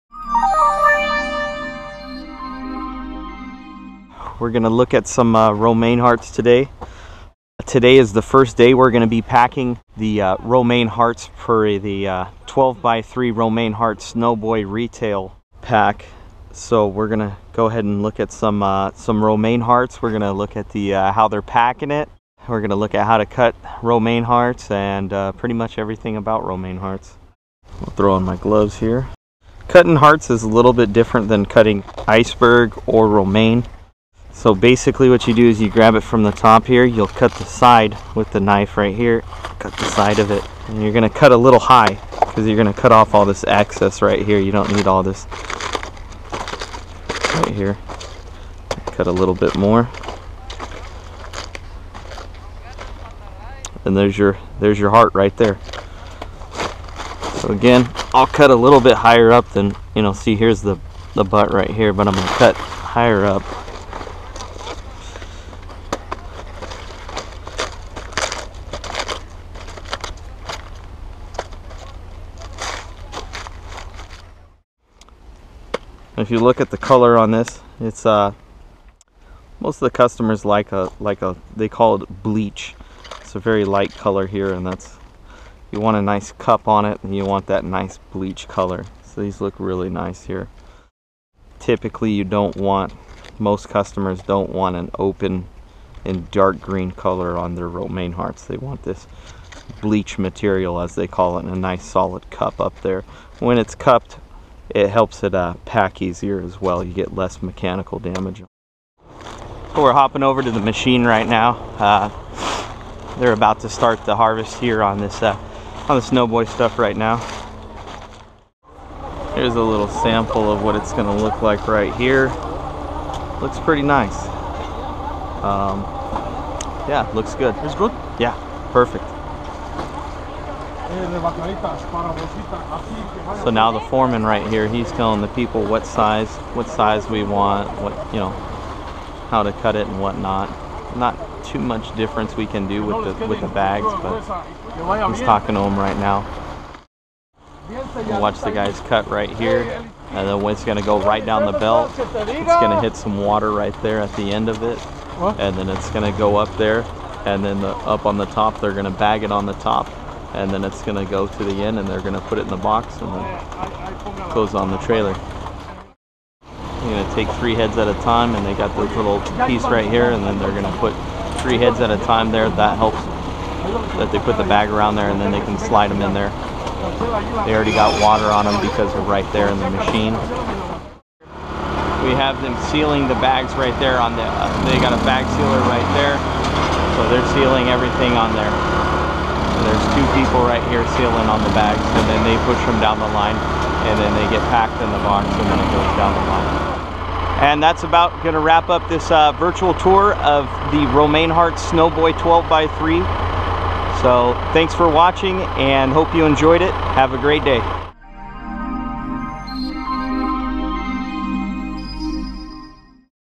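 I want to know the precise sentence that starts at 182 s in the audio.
We have them sealing the bags right there on the, uh, they got a bag sealer right there.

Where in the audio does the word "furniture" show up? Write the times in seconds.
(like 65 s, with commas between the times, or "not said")
not said.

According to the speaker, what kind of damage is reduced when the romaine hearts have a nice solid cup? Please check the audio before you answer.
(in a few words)
mechanical damage.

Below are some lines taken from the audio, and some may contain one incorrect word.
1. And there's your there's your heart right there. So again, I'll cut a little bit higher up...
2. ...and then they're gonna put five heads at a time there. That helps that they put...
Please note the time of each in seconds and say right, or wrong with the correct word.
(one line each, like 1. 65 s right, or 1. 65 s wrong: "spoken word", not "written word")
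1. 53 s right
2. 170 s wrong: "three", not "five".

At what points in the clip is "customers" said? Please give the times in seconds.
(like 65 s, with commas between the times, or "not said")
79 s, 93 s.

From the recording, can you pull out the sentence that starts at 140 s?
Not too much difference we can do with the, with the bags, but he's talking to them right now.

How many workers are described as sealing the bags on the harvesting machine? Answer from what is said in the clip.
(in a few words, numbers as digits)
2.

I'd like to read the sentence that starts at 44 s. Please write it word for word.
You don't need all this right here.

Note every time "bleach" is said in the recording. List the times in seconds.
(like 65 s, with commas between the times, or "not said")
82 s, 88 s, 99 s.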